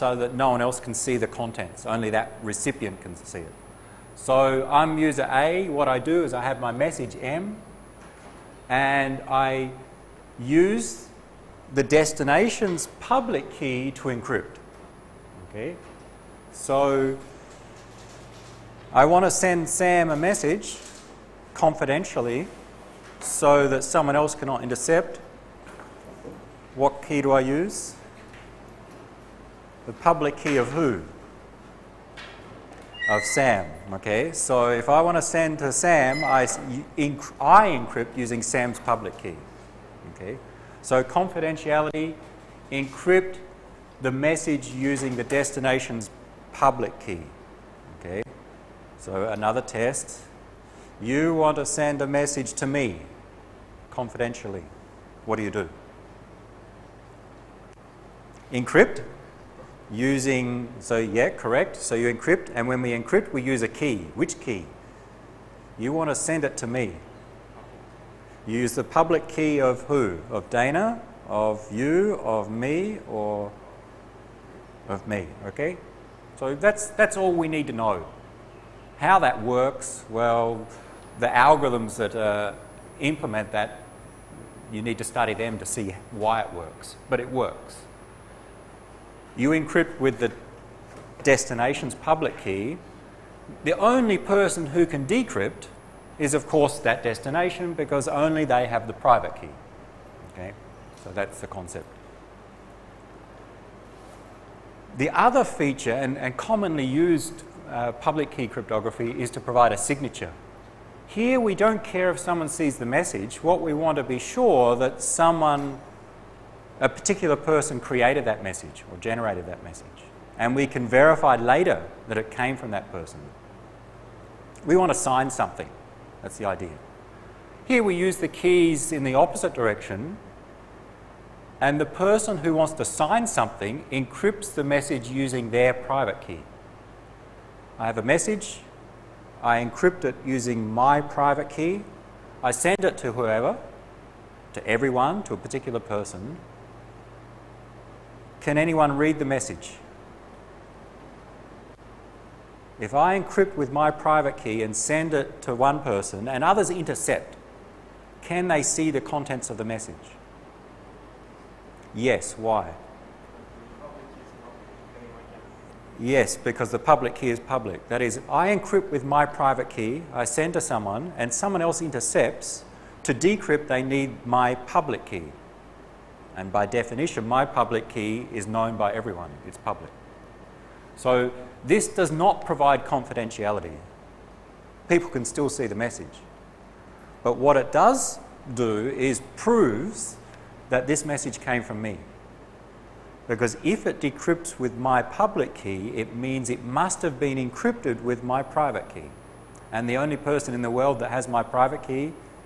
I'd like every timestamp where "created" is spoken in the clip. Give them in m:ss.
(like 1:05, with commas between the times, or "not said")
1:57.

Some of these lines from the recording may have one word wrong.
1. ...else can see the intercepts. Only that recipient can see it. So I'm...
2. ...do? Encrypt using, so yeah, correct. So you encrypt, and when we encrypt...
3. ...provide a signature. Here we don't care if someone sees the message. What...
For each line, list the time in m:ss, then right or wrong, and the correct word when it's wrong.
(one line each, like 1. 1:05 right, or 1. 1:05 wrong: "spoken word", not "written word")
1. 0:00 wrong: "contents", not "intercepts"
2. 0:55 right
3. 1:49 right.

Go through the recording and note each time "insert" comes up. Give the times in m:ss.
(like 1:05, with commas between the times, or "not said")
not said.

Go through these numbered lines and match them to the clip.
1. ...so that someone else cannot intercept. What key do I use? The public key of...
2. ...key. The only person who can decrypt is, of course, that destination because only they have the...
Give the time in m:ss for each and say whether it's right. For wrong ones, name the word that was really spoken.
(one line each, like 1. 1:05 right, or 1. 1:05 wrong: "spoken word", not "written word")
1. 0:23 right
2. 1:32 right.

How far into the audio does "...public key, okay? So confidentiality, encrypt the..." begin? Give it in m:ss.
0:38.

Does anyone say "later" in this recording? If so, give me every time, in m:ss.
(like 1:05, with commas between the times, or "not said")
2:01.